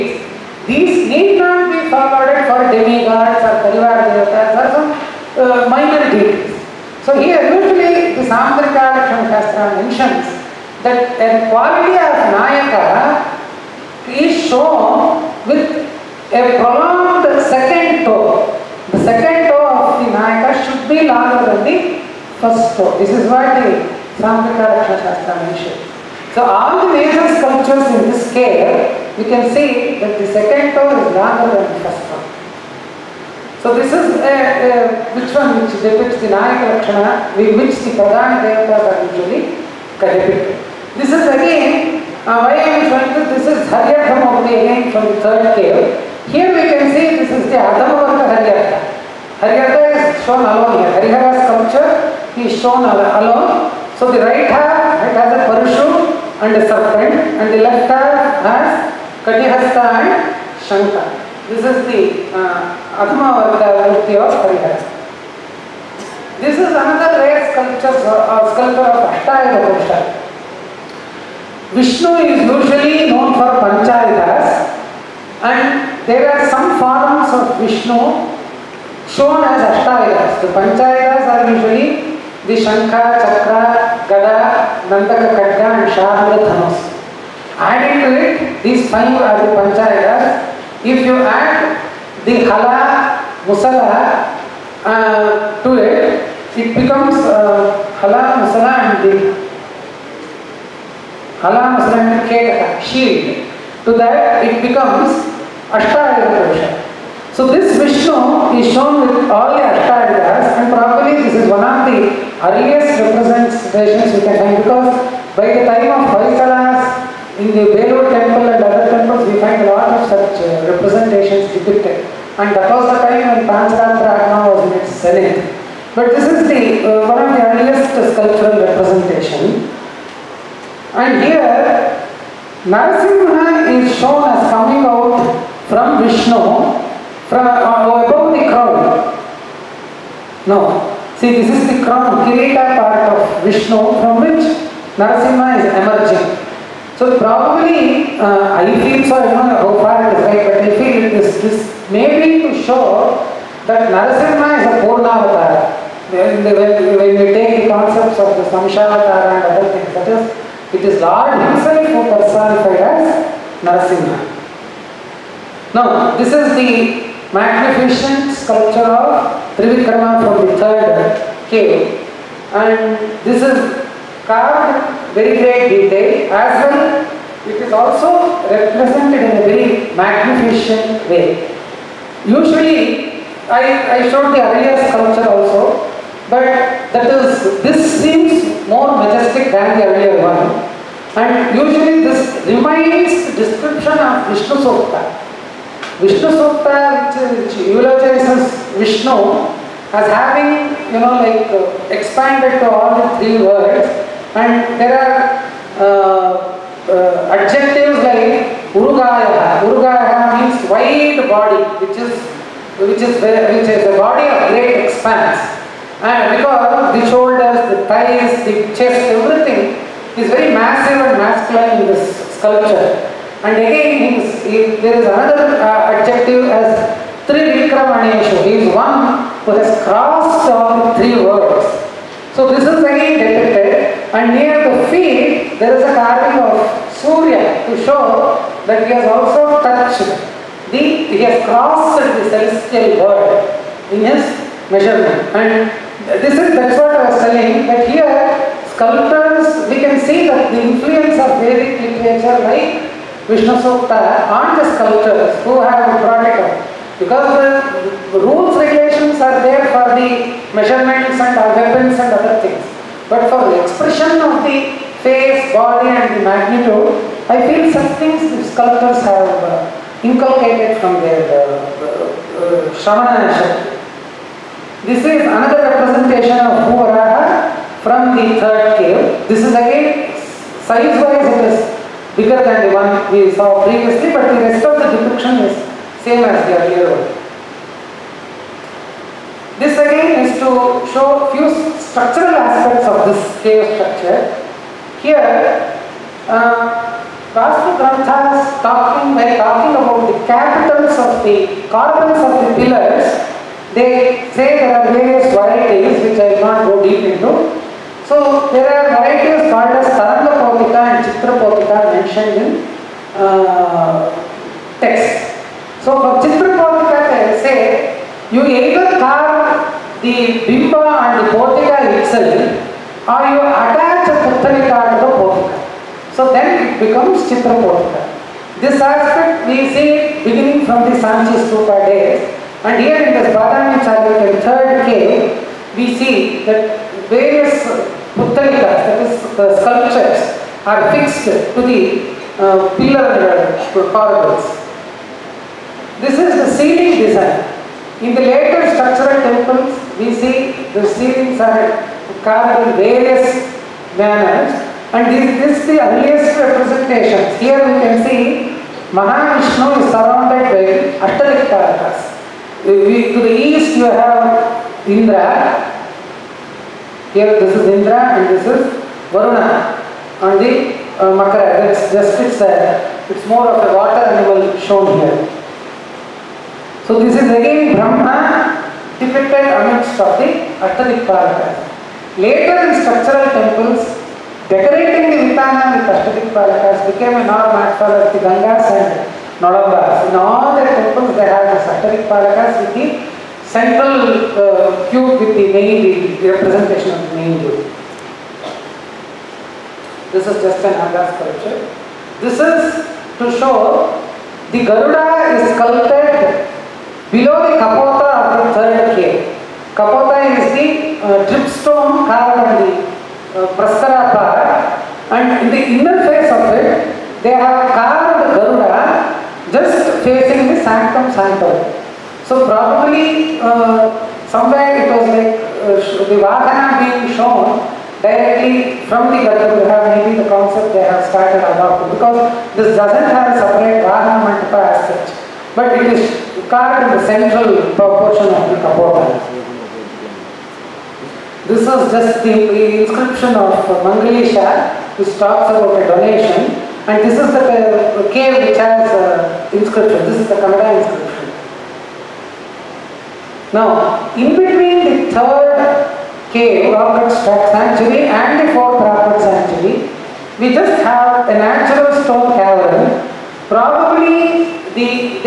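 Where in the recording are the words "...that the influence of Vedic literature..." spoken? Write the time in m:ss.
4:10.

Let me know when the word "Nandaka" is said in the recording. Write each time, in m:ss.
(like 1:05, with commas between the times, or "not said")
1:24.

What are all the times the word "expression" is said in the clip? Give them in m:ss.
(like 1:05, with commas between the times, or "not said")
4:23.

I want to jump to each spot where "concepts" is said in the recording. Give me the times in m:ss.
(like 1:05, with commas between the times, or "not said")
2:37, 7:10.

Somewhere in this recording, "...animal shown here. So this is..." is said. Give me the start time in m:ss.
6:14.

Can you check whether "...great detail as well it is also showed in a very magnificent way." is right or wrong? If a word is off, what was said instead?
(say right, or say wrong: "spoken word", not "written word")
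wrong: "represented", not "showed".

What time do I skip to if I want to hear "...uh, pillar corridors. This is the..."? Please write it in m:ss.
5:42.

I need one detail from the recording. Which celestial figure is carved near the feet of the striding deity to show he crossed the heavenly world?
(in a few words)
Surya.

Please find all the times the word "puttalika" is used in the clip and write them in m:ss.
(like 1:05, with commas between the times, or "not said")
5:24, 5:38.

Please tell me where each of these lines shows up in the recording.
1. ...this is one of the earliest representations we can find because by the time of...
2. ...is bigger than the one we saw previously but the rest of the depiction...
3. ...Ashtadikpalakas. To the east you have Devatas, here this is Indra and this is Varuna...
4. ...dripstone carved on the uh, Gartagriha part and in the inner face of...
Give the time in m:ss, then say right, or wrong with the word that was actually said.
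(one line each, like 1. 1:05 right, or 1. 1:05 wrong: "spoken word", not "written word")
1. 1:51 right
2. 4:41 right
3. 6:01 wrong: "Indra", not "Devatas"
4. 6:51 wrong: "Prasara", not "Gartagriha".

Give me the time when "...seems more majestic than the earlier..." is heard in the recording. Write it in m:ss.
3:08.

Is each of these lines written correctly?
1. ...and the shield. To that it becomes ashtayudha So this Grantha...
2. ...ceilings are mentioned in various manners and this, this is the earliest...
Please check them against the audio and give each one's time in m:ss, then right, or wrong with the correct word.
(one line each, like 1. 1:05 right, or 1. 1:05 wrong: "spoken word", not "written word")
1. 1:41 wrong: "Vishnu", not "Grantha"
2. 5:50 wrong: "carved", not "mentioned".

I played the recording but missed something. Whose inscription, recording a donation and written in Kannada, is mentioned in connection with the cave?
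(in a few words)
Mangalisha.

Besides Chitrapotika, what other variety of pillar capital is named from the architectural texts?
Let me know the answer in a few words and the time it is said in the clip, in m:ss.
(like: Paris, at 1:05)
Tarangapotika, at 5:09.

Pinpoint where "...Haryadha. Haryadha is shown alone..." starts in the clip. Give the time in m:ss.
0:48.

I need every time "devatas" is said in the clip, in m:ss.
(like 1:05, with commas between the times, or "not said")
0:04, 0:38.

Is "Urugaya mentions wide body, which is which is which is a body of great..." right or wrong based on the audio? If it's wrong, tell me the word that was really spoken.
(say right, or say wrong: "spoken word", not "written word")
wrong: "means", not "mentions".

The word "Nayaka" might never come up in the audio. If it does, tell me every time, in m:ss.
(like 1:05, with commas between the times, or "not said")
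0:12, 0:20, 0:36.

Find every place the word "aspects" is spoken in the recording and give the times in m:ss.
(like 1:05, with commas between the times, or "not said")
4:52, 5:28.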